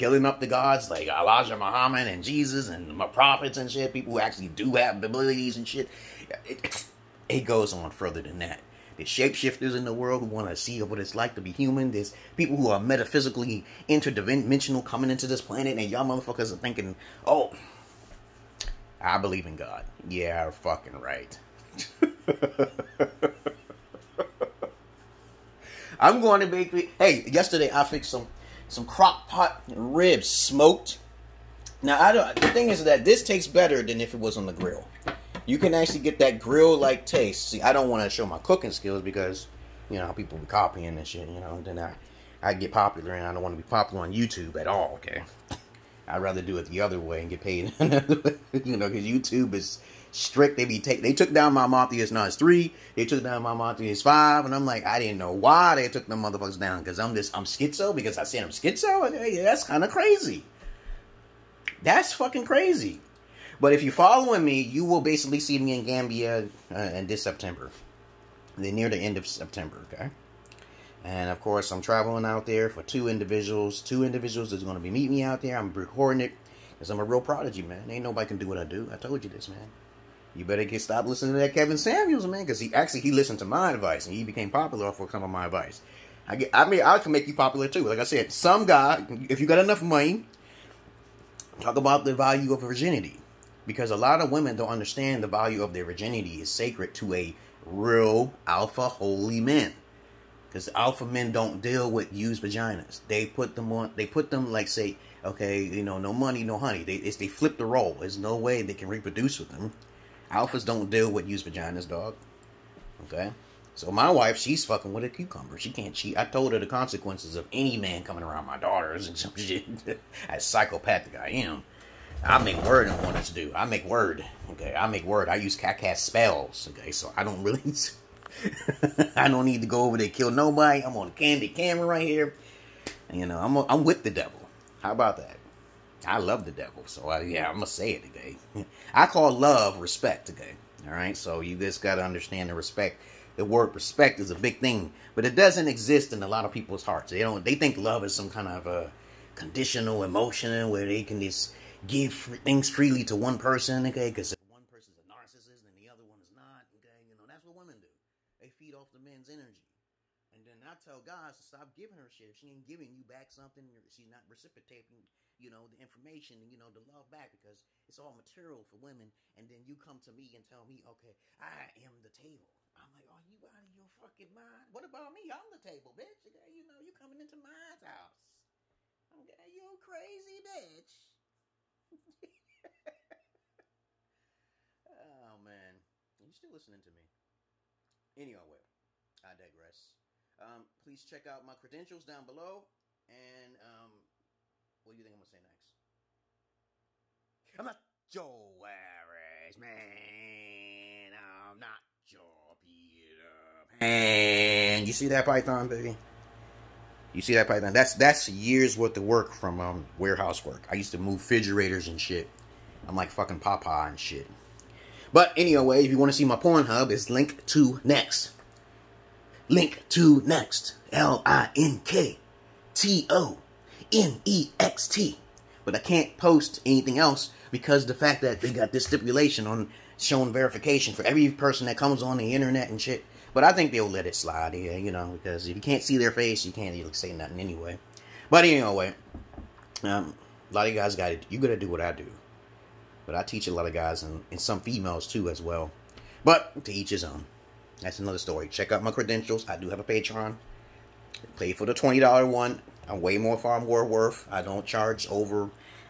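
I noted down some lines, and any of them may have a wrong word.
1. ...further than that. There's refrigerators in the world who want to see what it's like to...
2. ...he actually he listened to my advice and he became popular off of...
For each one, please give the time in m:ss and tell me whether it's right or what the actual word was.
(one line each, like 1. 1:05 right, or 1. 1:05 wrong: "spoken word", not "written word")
1. 0:07 wrong: "shapeshifters", not "refrigerators"
2. 1:22 right.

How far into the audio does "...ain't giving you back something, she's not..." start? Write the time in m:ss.
2:42.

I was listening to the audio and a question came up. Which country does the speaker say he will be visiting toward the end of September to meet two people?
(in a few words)
Gambia.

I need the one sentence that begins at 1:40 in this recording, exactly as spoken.
Because alpha men don't deal with used vaginas.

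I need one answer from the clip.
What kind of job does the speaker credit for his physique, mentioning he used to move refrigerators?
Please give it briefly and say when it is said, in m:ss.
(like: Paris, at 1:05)
warehouse work, at 3:29.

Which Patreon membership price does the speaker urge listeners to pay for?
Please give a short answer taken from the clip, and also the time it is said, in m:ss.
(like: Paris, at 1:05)
$20, at 4:11.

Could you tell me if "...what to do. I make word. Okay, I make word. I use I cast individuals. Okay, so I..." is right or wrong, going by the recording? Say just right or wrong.
wrong.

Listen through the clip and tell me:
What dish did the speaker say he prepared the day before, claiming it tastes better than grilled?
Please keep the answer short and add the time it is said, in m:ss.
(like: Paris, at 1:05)
crock pot ribs, at 0:28.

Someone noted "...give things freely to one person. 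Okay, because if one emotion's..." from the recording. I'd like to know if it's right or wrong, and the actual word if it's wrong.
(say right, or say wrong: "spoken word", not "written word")
wrong: "person", not "emotion".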